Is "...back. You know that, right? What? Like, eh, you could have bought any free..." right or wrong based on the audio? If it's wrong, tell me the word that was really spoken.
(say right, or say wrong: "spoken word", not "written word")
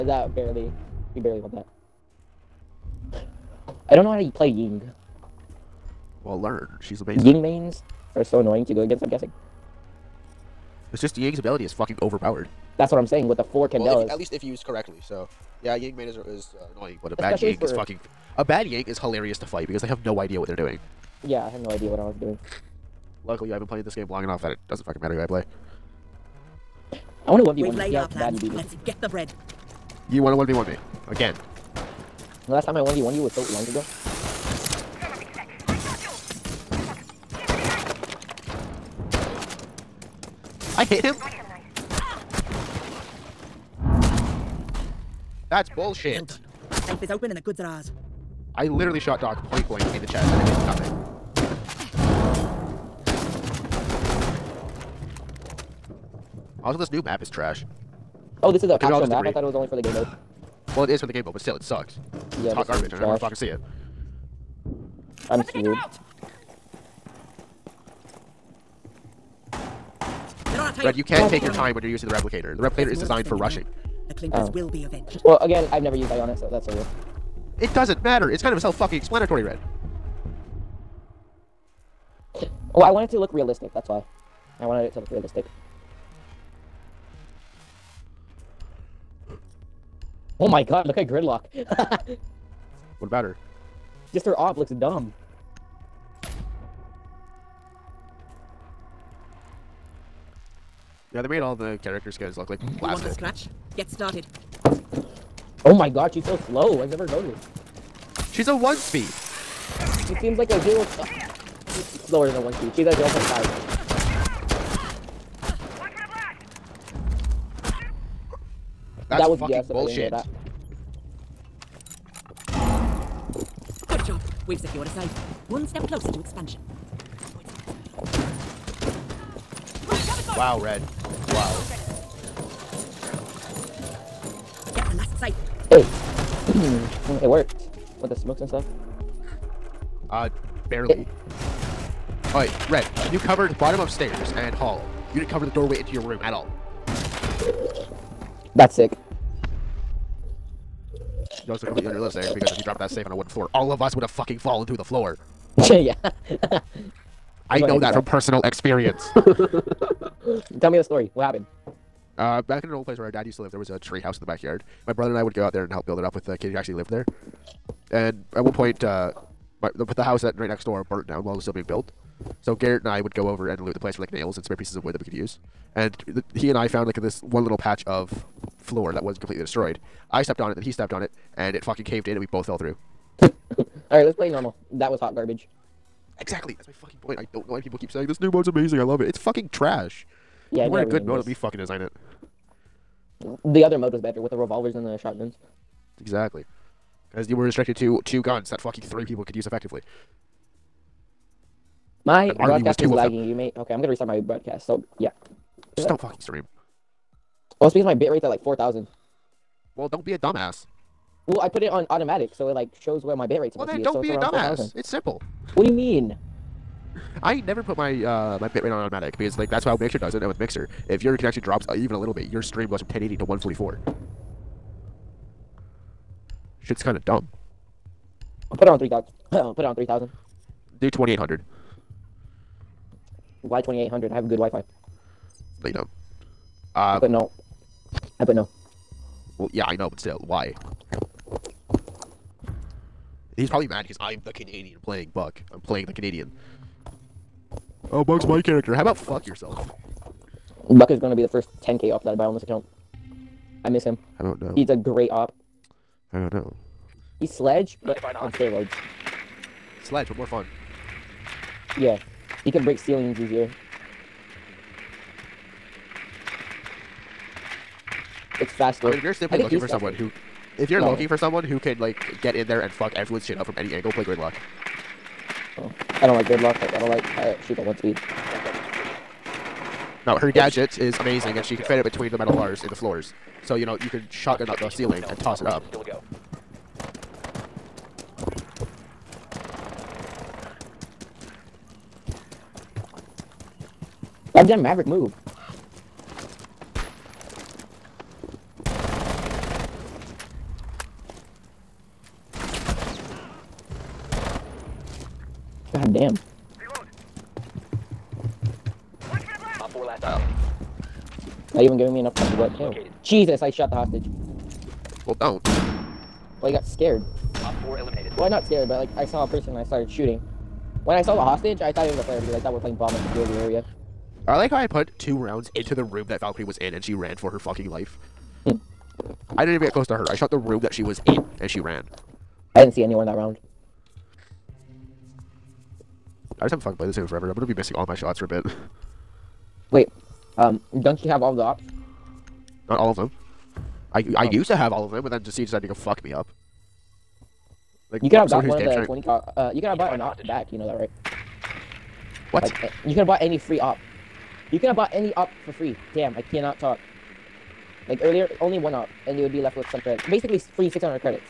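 right.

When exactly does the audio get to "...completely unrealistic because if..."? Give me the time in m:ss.
2:31.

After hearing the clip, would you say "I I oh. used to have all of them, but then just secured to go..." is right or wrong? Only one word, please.
wrong.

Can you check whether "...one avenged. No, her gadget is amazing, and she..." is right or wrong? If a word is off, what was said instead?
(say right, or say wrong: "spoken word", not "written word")
wrong: "speed", not "avenged".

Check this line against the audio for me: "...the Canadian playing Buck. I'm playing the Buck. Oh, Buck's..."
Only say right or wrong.
wrong.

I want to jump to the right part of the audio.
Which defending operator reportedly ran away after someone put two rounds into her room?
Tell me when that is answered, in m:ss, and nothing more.
5:26.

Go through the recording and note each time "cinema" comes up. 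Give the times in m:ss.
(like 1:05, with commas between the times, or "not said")
not said.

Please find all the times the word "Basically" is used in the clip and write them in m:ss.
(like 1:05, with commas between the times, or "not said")
6:00.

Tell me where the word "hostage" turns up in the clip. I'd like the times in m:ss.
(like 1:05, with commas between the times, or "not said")
5:13, 5:21.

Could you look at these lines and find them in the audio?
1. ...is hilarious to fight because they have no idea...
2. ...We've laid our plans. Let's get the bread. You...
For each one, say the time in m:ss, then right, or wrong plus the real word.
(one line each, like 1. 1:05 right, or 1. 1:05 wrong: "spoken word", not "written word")
1. 0:18 right
2. 0:27 right.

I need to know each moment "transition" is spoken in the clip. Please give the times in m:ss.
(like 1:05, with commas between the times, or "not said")
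not said.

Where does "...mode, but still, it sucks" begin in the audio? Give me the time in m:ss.
1:01.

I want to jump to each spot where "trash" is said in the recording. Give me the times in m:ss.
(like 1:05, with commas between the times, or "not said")
0:57, 3:09.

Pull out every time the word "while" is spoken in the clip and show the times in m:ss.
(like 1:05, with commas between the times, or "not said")
2:51.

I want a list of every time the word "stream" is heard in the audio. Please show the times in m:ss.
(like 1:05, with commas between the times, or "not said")
3:26, 3:42.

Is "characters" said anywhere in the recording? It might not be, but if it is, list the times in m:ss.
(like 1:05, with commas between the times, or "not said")
1:41, 4:08.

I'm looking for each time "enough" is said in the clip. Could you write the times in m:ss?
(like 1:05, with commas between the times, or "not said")
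0:24, 5:11.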